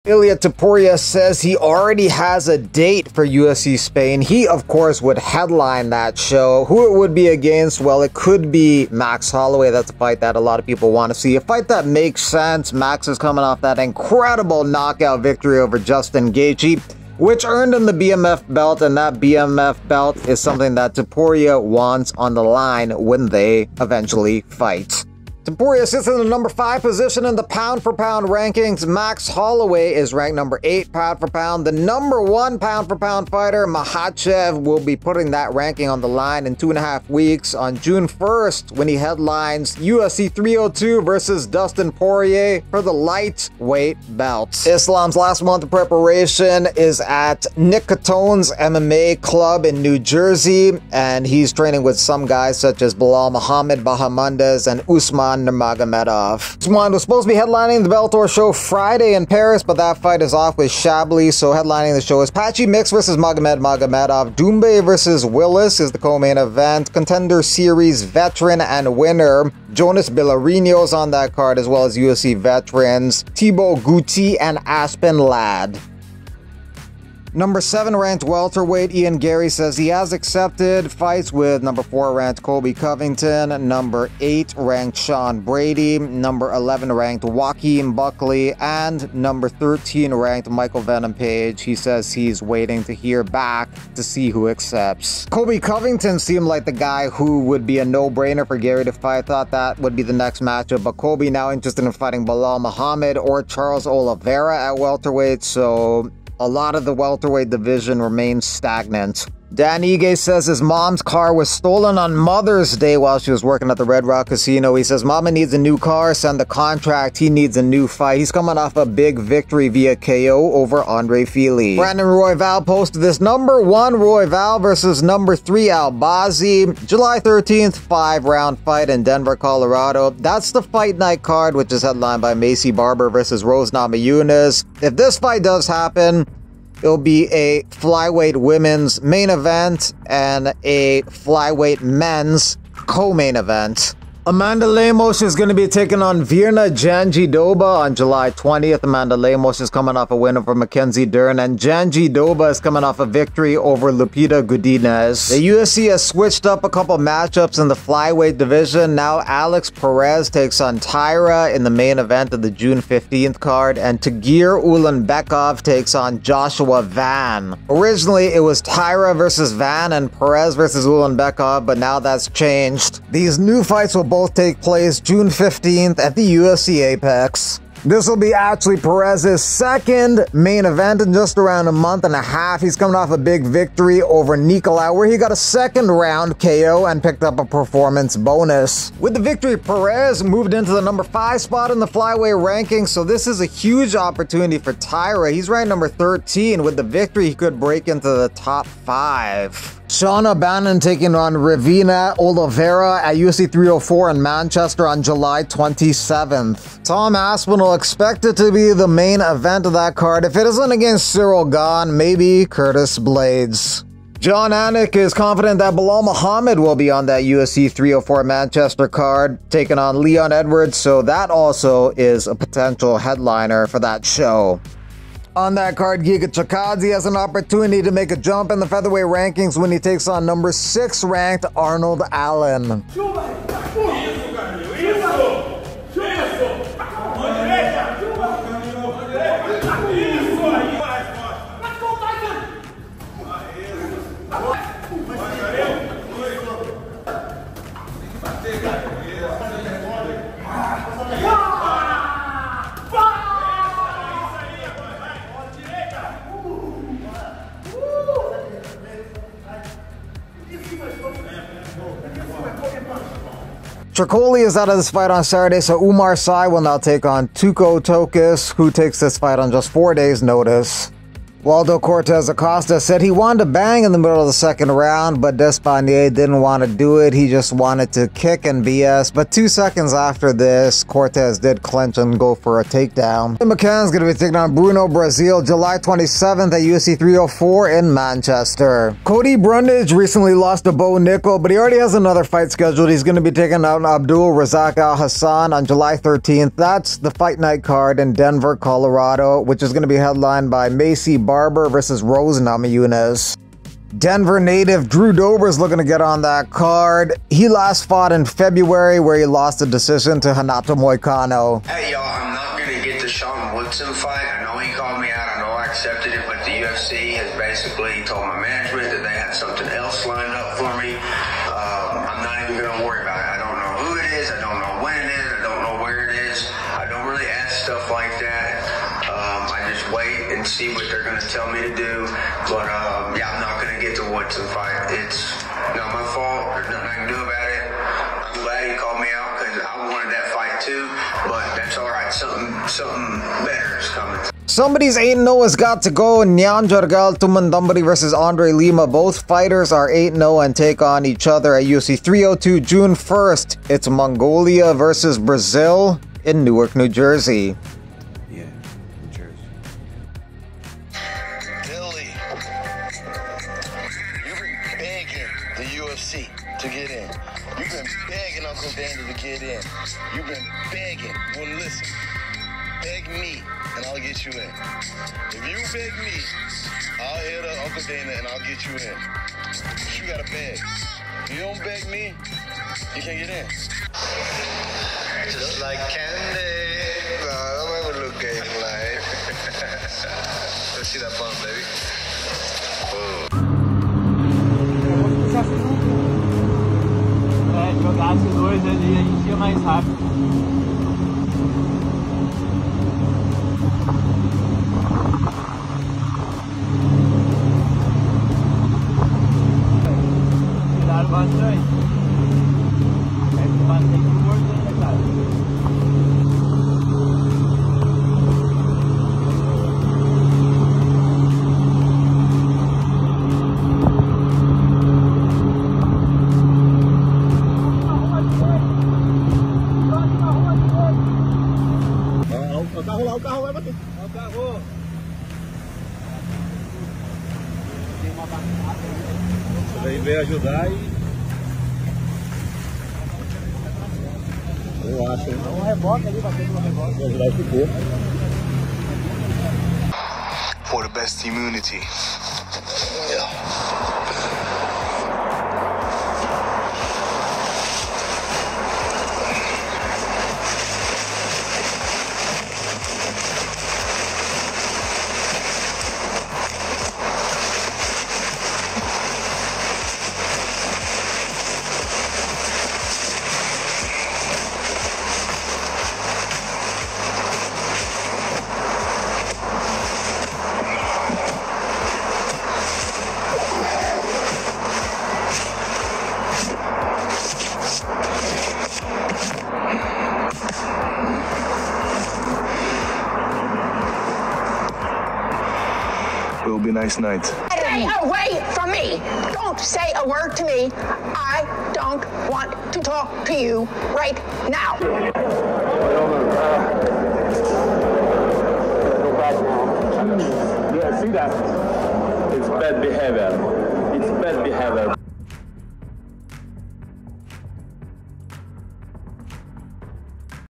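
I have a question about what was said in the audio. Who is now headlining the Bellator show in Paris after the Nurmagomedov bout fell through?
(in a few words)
Patchy Mix versus Magomed Magomedov.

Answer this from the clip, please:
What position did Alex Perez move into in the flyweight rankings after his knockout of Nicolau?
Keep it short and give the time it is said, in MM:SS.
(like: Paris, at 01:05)
number 5, at 03:10.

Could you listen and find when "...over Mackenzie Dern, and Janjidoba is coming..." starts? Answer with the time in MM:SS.
02:30.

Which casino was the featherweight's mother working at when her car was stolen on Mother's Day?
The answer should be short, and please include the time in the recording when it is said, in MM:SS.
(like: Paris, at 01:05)
Red Rock Casino, at 01:53.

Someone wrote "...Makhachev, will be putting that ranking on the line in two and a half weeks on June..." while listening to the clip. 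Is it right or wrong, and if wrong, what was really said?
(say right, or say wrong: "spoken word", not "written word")
right.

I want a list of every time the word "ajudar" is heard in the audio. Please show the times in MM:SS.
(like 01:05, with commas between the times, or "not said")
07:20, 07:27.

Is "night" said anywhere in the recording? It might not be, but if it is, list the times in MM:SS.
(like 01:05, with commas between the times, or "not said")
02:10, 04:57, 08:16.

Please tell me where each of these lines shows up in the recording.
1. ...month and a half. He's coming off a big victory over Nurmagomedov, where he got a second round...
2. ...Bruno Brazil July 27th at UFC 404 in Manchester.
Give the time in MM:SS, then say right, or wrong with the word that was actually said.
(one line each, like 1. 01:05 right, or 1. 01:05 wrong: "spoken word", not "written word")
1. 03:01 wrong: "Nicolau", not "Nurmagomedov"
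2. 04:44 wrong: "304", not "404".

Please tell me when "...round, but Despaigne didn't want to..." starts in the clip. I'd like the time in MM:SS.
04:34.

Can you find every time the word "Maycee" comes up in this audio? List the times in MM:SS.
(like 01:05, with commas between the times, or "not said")
02:12, 05:00.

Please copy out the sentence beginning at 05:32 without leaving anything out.
But um, yeah, I'm not gonna get to Woodson fight.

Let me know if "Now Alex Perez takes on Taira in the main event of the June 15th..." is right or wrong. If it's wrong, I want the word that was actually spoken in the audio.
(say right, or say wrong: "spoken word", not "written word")
right.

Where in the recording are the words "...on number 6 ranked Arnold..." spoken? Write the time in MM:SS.
03:50.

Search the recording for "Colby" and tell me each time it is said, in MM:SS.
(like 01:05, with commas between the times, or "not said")
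01:22, 01:35, 01:40.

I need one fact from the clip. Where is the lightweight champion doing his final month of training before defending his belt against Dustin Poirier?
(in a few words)
Nick Catone's MMA club.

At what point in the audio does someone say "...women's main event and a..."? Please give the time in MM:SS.
02:18.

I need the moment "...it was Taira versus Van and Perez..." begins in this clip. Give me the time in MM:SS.
02:48.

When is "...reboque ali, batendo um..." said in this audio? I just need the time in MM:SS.
07:25.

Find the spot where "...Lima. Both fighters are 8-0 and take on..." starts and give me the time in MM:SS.
05:48.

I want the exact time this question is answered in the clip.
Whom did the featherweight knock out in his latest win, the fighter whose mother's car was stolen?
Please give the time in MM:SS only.
02:00.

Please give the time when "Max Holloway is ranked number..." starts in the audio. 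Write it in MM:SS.
00:28.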